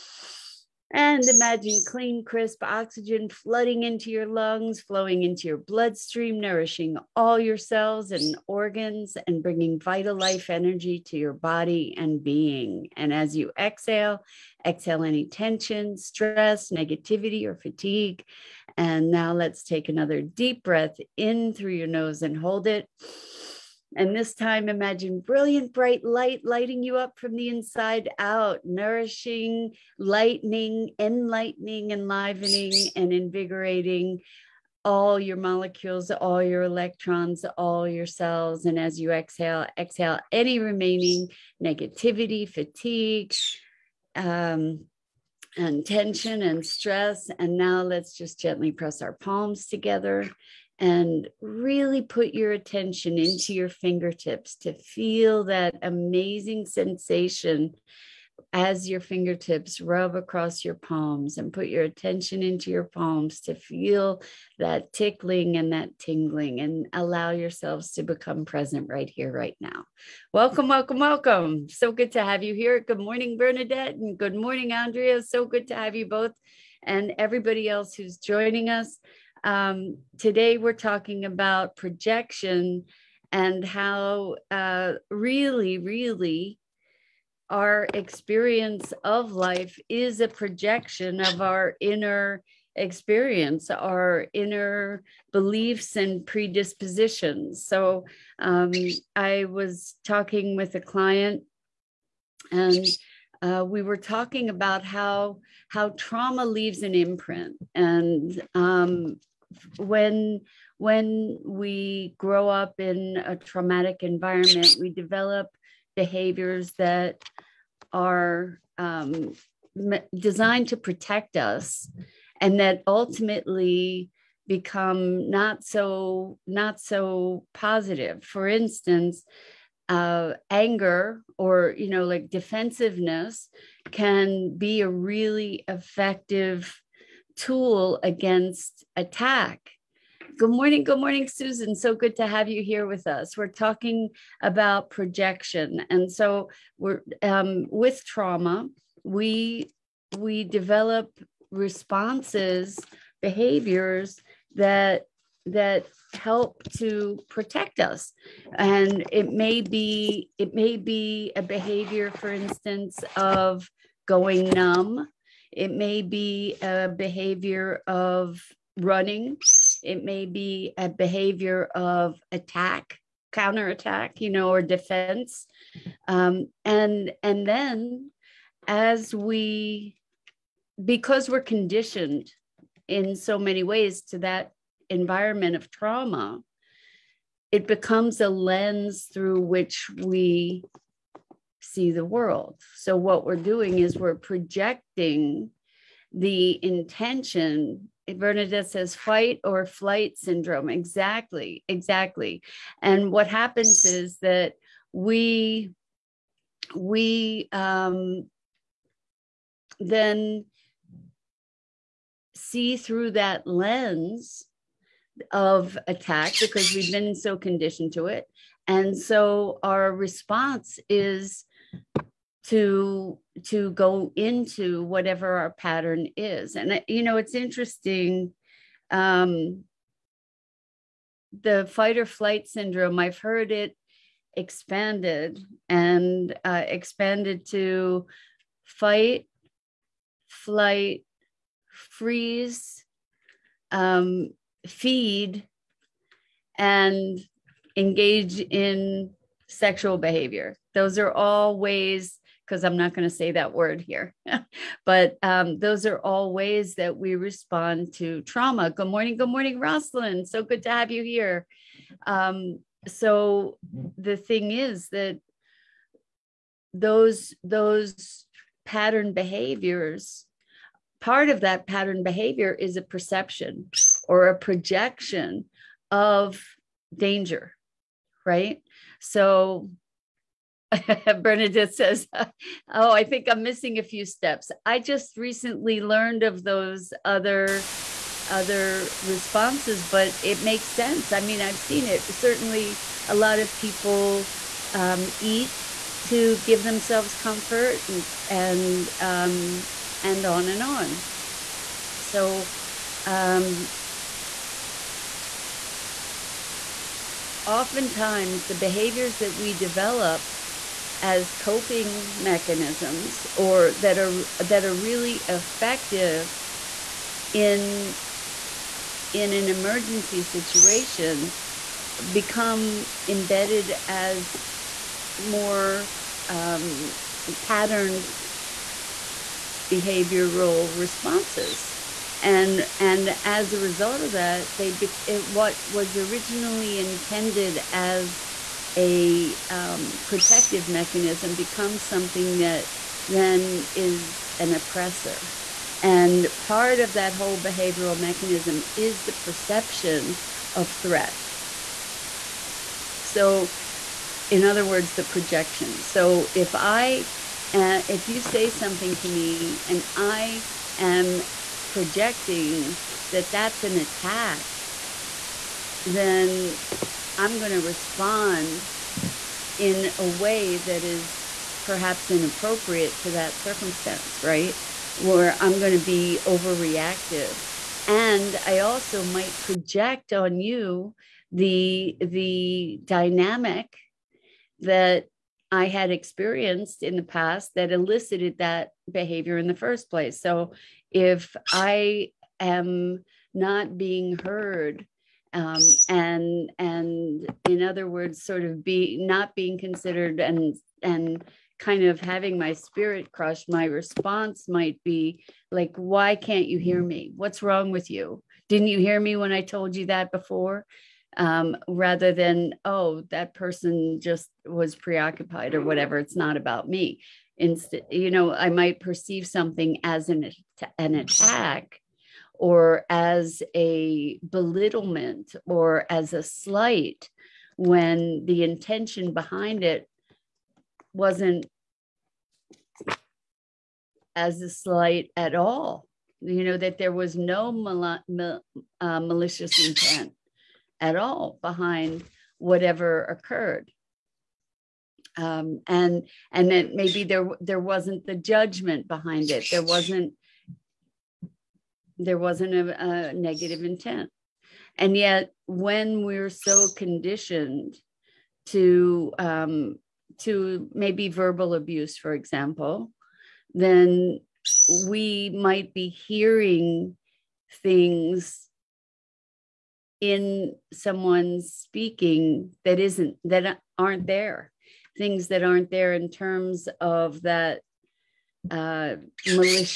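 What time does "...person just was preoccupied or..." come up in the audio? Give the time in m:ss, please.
6:53.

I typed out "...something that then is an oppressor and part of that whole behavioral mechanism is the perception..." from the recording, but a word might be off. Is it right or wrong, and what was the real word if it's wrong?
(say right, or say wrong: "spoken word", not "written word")
right.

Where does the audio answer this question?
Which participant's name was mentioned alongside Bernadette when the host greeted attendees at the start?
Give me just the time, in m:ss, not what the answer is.
1:14.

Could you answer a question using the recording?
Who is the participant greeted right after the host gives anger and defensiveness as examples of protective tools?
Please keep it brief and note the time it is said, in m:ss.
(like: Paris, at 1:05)
Susan, at 2:21.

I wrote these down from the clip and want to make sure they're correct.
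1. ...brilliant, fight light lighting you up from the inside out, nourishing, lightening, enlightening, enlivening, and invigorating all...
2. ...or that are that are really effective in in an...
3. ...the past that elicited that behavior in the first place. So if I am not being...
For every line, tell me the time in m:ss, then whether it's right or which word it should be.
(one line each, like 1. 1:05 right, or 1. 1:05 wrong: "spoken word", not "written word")
1. 0:25 wrong: "bright", not "fight"
2. 5:13 right
3. 6:26 right.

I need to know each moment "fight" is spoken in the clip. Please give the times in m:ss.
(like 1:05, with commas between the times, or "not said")
3:18, 3:51, 3:58.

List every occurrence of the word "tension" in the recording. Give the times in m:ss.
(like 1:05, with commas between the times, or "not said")
0:15, 0:45.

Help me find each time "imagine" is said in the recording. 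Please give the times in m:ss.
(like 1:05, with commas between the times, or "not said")
0:01, 0:24.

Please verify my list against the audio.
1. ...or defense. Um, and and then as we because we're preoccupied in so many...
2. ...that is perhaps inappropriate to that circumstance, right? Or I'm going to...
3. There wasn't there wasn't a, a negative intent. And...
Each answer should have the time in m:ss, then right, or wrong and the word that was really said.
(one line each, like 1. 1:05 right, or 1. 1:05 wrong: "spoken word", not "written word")
1. 2:54 wrong: "conditioned", not "preoccupied"
2. 6:10 right
3. 7:29 right.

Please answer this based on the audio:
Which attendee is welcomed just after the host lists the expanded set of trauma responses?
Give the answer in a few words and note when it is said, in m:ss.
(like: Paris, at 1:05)
Rosalind, at 4:19.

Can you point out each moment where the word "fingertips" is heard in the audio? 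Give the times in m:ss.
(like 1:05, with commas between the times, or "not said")
0:53, 0:59.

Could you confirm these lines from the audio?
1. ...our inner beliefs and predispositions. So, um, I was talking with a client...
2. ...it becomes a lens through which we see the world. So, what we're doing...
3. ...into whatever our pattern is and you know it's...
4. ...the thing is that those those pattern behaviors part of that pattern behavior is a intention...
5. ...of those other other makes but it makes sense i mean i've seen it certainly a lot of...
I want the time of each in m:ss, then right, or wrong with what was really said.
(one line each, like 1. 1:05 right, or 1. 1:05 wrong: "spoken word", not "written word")
1. 1:33 right
2. 3:07 right
3. 3:44 right
4. 4:23 wrong: "perception", not "intention"
5. 4:46 wrong: "responses", not "makes".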